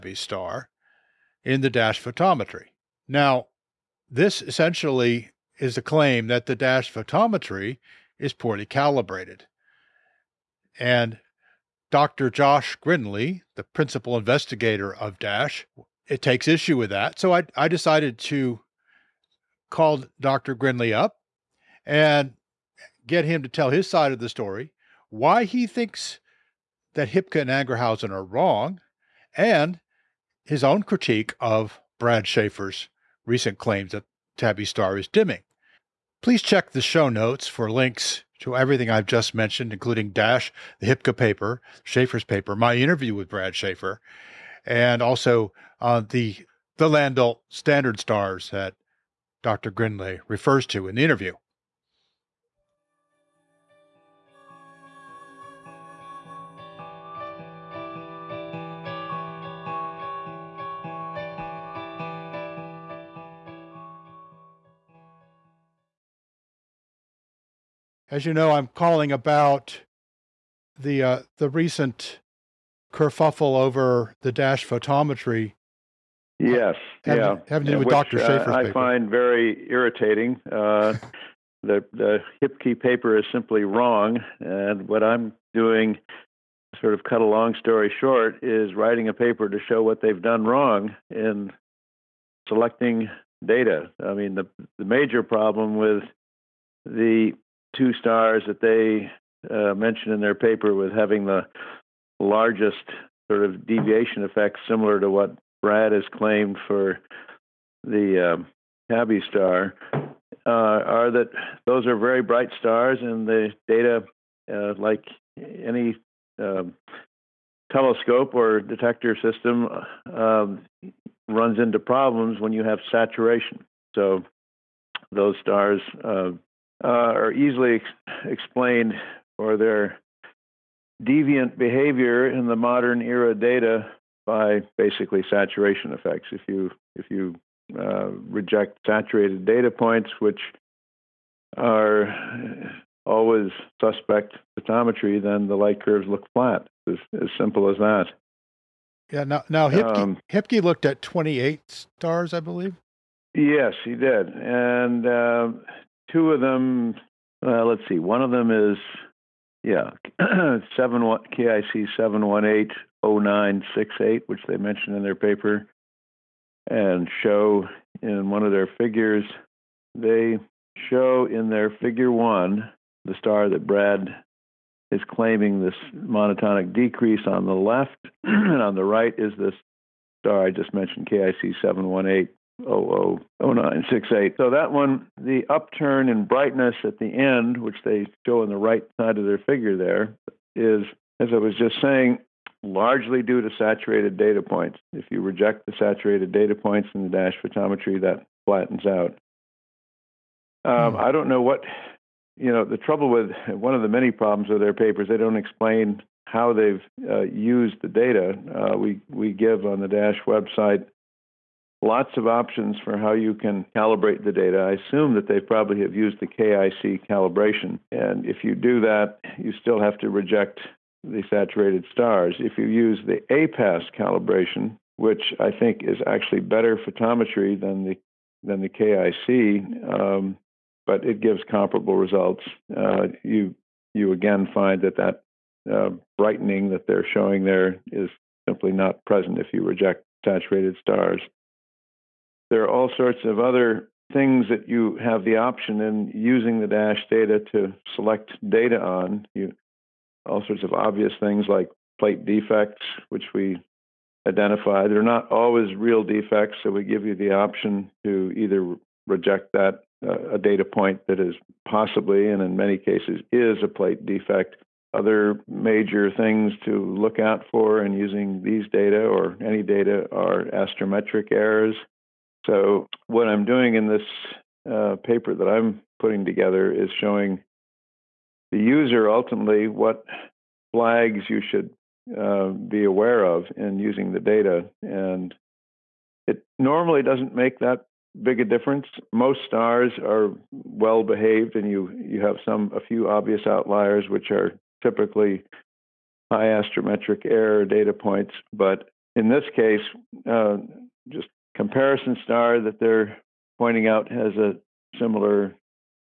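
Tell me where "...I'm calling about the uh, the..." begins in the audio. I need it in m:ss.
1:08.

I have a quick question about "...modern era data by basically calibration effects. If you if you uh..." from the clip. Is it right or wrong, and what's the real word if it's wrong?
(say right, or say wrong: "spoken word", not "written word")
wrong: "saturation", not "calibration".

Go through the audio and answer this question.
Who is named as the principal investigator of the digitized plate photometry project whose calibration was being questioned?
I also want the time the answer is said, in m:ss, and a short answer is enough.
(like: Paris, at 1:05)
Josh Grindlay, at 0:11.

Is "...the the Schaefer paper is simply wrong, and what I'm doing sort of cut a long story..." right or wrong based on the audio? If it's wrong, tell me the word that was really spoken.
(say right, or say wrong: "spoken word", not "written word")
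wrong: "Hippke", not "Schaefer".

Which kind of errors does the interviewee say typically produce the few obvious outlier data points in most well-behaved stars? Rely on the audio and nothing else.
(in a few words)
Astrometric errors.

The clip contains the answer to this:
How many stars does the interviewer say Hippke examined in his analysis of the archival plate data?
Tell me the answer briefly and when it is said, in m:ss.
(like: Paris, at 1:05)
28, at 2:31.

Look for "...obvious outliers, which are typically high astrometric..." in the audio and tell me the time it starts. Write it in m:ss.
4:53.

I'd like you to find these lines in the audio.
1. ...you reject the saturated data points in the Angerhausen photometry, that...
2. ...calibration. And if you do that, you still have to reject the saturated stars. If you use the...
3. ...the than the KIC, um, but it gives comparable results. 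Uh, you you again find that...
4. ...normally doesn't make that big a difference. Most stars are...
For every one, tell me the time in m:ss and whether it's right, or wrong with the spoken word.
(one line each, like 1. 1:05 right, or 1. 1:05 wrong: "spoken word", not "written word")
1. 3:15 wrong: "DASCH", not "Angerhausen"
2. 3:37 right
3. 3:47 right
4. 4:46 right.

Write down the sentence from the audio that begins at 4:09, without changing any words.
You all sorts of obvious things like plate defects, which we identify.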